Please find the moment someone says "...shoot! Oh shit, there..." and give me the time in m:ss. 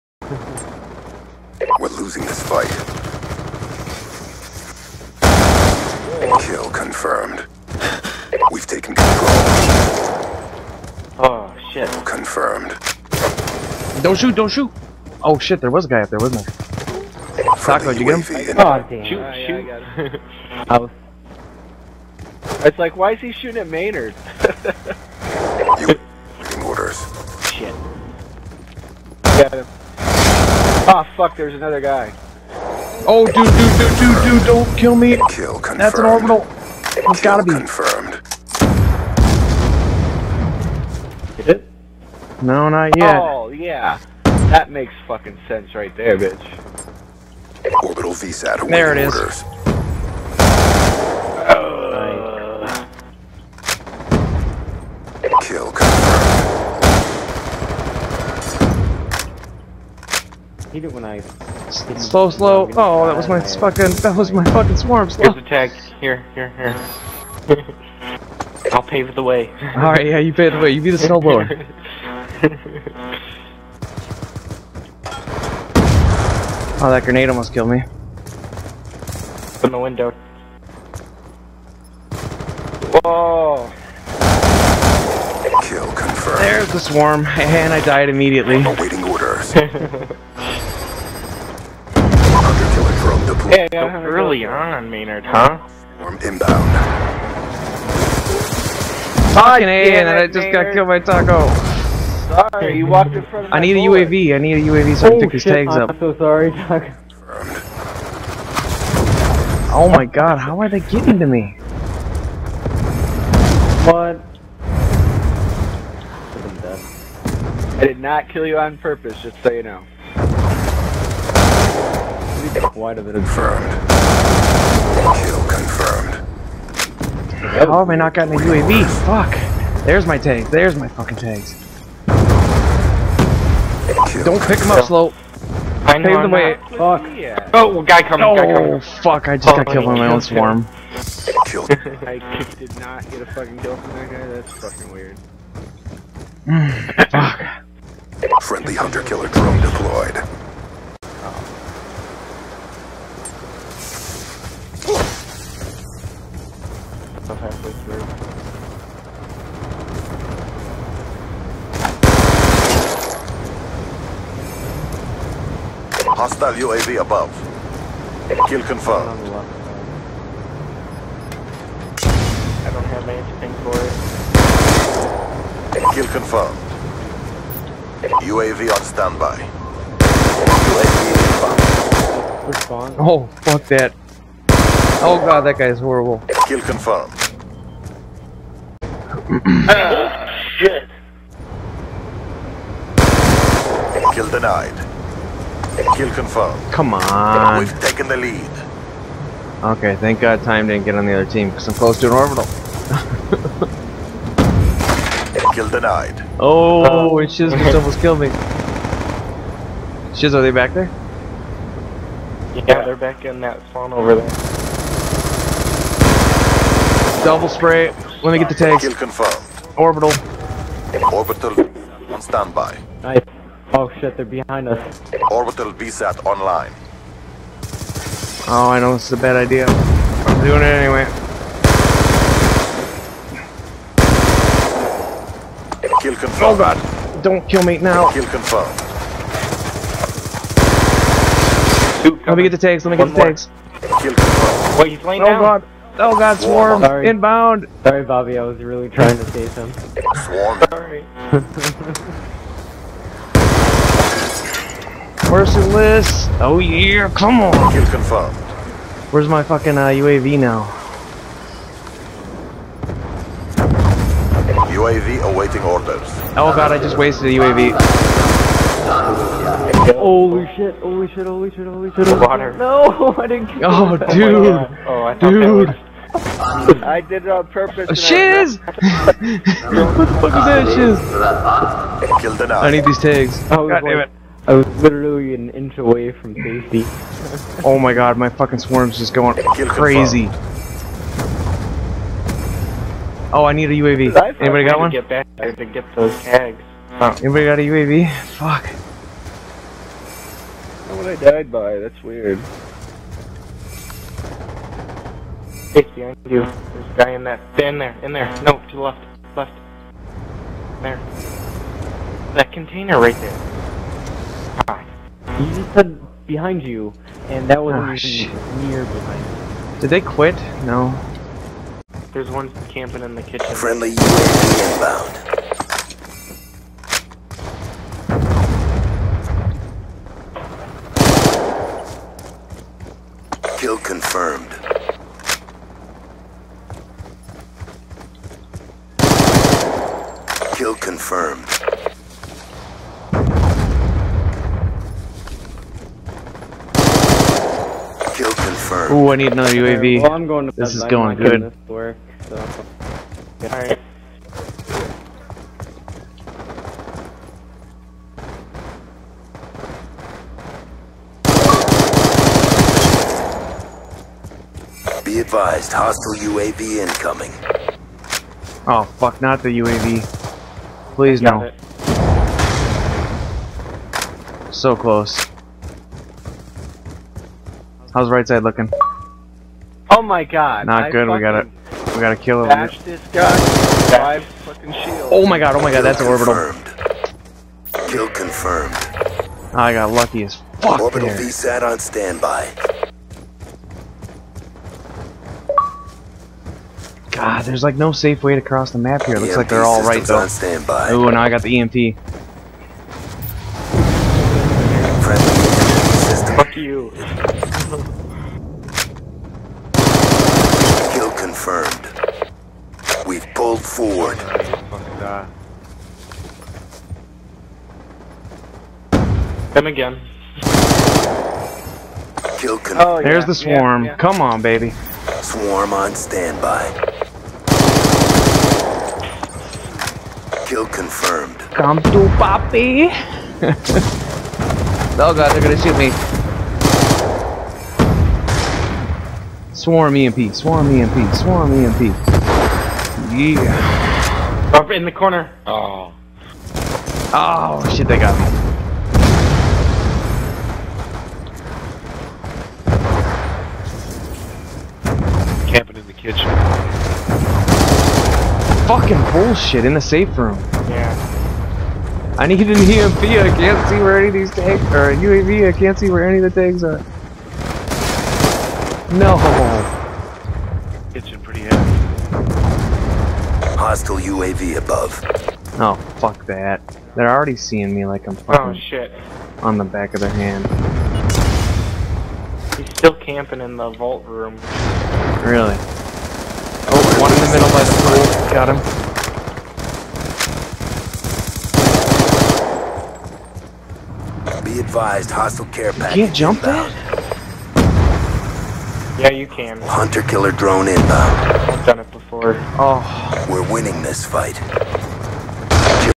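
0:14.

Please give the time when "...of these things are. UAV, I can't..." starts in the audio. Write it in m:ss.
7:44.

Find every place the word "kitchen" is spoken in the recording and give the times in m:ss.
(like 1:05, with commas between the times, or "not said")
5:23, 7:35.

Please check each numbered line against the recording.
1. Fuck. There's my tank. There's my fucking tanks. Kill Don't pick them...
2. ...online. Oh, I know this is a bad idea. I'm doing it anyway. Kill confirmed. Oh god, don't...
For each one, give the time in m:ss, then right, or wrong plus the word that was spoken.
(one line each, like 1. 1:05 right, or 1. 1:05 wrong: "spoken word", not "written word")
1. 2:09 right
2. 3:46 right.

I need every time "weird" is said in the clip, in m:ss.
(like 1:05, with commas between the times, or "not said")
2:24, 5:02.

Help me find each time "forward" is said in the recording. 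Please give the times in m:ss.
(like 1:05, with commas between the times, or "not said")
6:53.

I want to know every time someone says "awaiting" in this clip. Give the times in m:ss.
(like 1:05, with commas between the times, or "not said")
0:48, 1:28, 4:25.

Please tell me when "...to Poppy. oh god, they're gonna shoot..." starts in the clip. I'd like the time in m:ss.
7:11.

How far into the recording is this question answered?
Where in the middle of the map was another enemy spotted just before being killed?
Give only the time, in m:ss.
8:07.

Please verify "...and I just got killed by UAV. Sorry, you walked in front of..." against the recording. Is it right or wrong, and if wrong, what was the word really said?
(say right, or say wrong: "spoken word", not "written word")
wrong: "Taco", not "UAV".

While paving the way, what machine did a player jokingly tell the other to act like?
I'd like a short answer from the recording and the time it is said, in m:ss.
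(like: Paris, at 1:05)
snowblower, at 1:10.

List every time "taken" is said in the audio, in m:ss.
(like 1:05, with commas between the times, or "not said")
0:08, 3:17.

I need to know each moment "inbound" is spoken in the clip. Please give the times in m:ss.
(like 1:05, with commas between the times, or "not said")
1:36, 3:02, 4:07, 5:24, 8:16, 8:20.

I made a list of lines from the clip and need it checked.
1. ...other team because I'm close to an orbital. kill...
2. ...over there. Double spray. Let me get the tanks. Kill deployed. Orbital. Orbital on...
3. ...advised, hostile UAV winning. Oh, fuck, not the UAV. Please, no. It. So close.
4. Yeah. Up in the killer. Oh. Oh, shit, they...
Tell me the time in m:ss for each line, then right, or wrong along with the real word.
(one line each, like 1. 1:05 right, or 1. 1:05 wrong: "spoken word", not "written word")
1. 3:21 right
2. 3:33 wrong: "confirmed", not "deployed"
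3. 6:05 wrong: "incoming", not "winning"
4. 7:23 wrong: "corner", not "killer".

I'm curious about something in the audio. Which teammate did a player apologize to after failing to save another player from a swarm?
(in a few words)
Bobby.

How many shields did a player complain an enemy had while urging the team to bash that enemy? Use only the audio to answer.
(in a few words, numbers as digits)
5.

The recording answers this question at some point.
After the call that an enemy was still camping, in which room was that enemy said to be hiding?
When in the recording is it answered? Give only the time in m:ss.
8:02.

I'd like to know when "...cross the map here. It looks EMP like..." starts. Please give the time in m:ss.
6:38.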